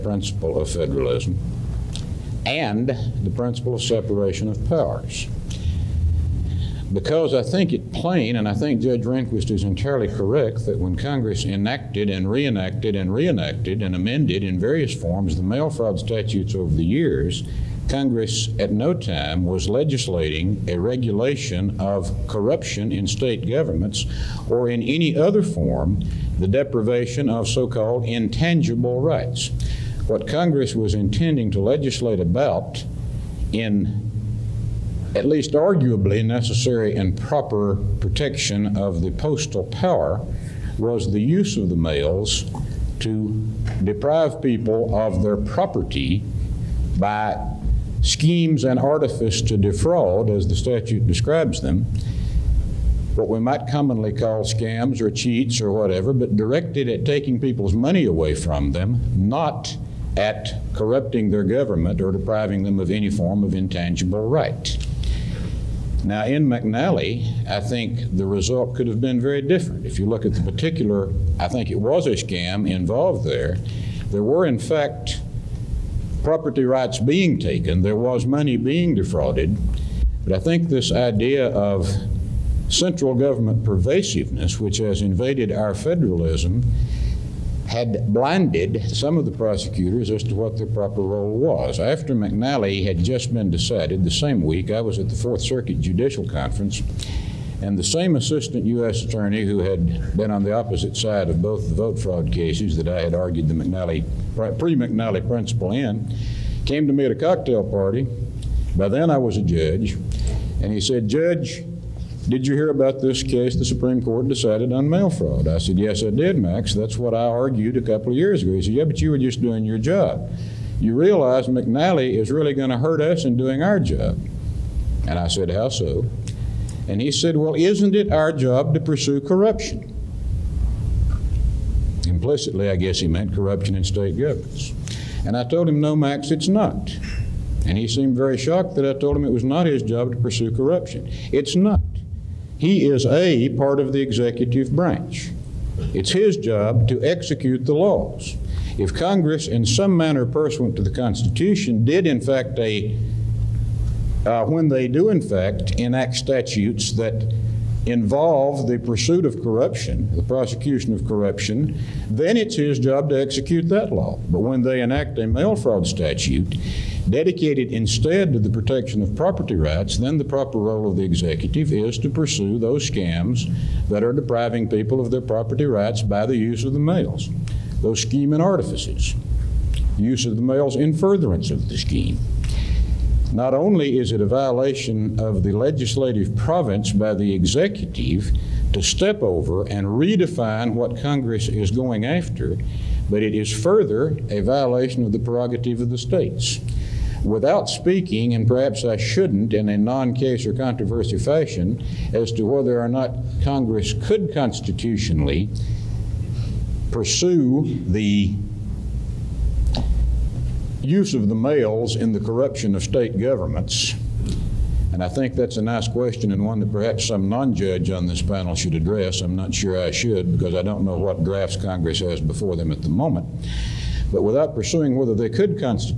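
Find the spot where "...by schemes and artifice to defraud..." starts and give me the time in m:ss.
0:46.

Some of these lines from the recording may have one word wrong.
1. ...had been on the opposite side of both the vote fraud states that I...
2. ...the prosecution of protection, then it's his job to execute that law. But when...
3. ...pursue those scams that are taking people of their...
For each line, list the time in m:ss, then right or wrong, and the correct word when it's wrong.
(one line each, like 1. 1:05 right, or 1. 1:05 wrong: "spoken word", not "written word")
1. 1:39 wrong: "cases", not "states"
2. 2:40 wrong: "corruption", not "protection"
3. 2:52 wrong: "depriving", not "taking".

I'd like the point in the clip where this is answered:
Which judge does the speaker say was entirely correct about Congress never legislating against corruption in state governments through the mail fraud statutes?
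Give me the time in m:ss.
0:08.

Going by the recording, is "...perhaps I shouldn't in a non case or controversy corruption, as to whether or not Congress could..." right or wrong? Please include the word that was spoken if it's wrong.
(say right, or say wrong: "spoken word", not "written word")
wrong: "fashion", not "corruption".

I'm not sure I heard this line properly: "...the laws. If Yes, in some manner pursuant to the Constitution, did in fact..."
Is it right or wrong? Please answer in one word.
wrong.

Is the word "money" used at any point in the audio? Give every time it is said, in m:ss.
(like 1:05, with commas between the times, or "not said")
0:57, 1:18.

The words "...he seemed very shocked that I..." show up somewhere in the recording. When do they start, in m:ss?
2:17.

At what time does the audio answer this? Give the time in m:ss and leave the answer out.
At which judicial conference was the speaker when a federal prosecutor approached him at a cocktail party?
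1:35.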